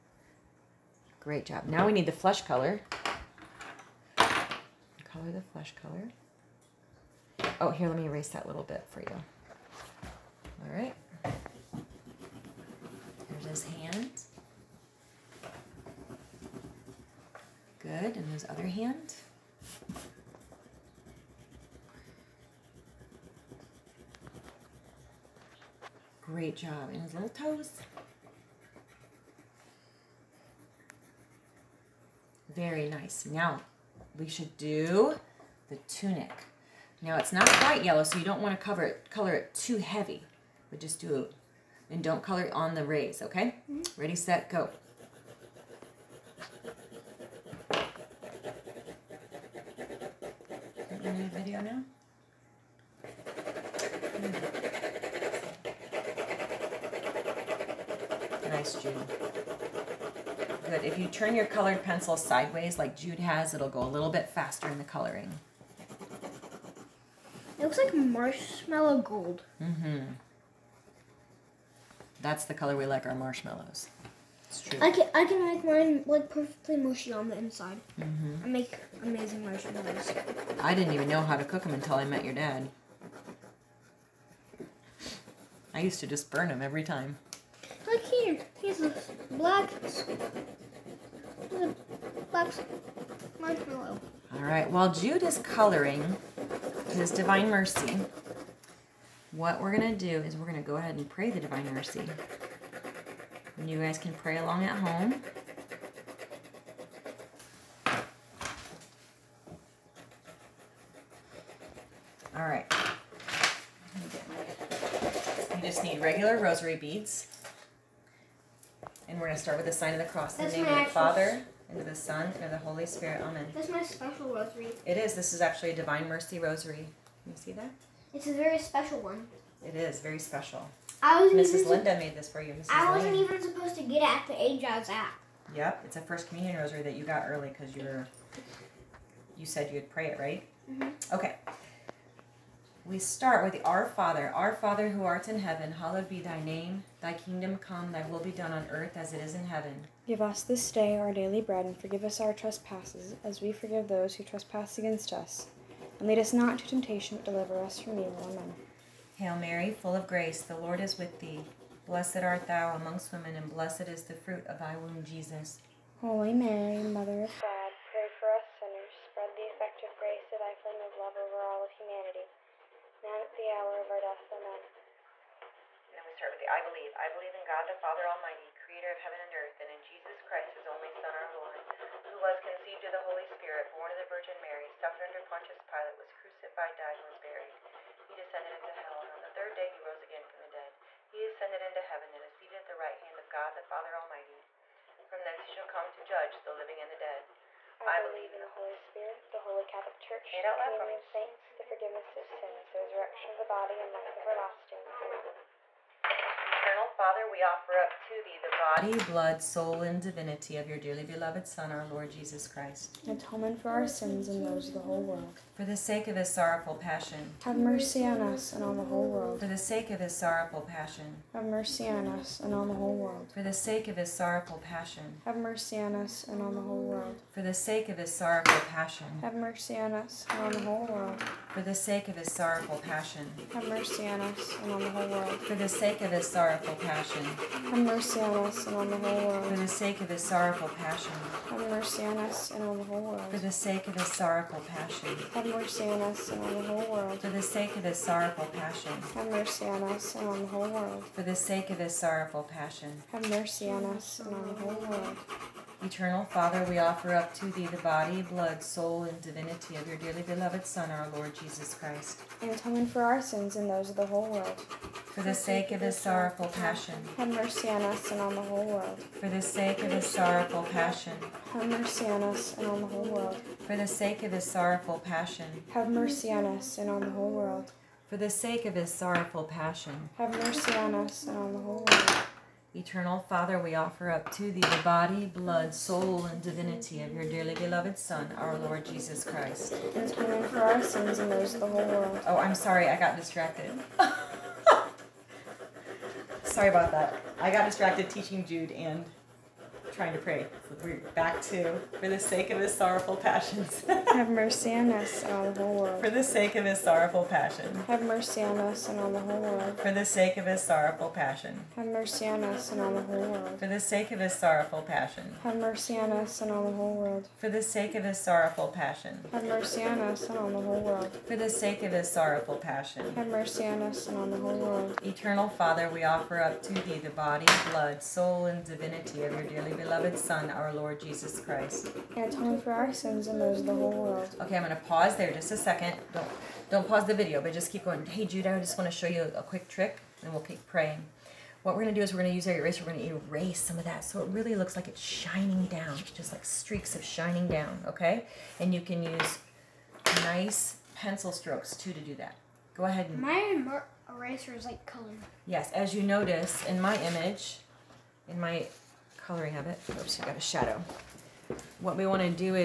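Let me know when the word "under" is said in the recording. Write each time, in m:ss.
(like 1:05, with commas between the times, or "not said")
3:05.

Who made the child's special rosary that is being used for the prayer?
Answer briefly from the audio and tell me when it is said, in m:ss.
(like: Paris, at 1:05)
Mrs. Linda, at 2:11.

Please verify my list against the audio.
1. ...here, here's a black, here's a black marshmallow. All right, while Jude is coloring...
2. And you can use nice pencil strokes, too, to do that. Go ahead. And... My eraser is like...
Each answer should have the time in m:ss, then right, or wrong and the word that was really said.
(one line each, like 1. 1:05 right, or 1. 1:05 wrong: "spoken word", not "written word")
1. 1:28 right
2. 5:48 right.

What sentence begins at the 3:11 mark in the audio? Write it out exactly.
He ascended into heaven and is seated at the right hand of God the Father Almighty.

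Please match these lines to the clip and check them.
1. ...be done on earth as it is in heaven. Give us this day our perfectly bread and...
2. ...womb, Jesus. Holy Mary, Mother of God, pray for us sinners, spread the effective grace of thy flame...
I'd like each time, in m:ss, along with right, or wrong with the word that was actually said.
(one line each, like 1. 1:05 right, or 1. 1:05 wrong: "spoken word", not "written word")
1. 2:28 wrong: "daily", not "perfectly"
2. 2:44 right.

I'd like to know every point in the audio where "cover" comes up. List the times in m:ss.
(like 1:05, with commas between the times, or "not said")
0:38.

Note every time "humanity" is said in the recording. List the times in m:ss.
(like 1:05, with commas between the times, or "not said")
2:51.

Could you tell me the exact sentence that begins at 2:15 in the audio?
Yep, it's a first communion rosary that you got early because you were, you said you'd pray it, right?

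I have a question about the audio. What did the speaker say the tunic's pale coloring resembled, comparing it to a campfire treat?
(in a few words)
Marshmallow gold.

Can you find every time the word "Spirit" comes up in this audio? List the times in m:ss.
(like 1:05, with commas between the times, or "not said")
2:02, 3:03, 3:18.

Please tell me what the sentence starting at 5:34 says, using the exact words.
Okay, I'm going to pause there just a second.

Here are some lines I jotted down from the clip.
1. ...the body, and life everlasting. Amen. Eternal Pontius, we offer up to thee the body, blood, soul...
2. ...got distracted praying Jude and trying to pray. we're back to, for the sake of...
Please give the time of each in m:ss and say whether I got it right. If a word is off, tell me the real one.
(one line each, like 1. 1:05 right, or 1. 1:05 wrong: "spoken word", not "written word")
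1. 3:23 wrong: "Father", not "Pontius"
2. 4:57 wrong: "teaching", not "praying".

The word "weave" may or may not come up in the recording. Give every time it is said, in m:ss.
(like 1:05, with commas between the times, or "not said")
not said.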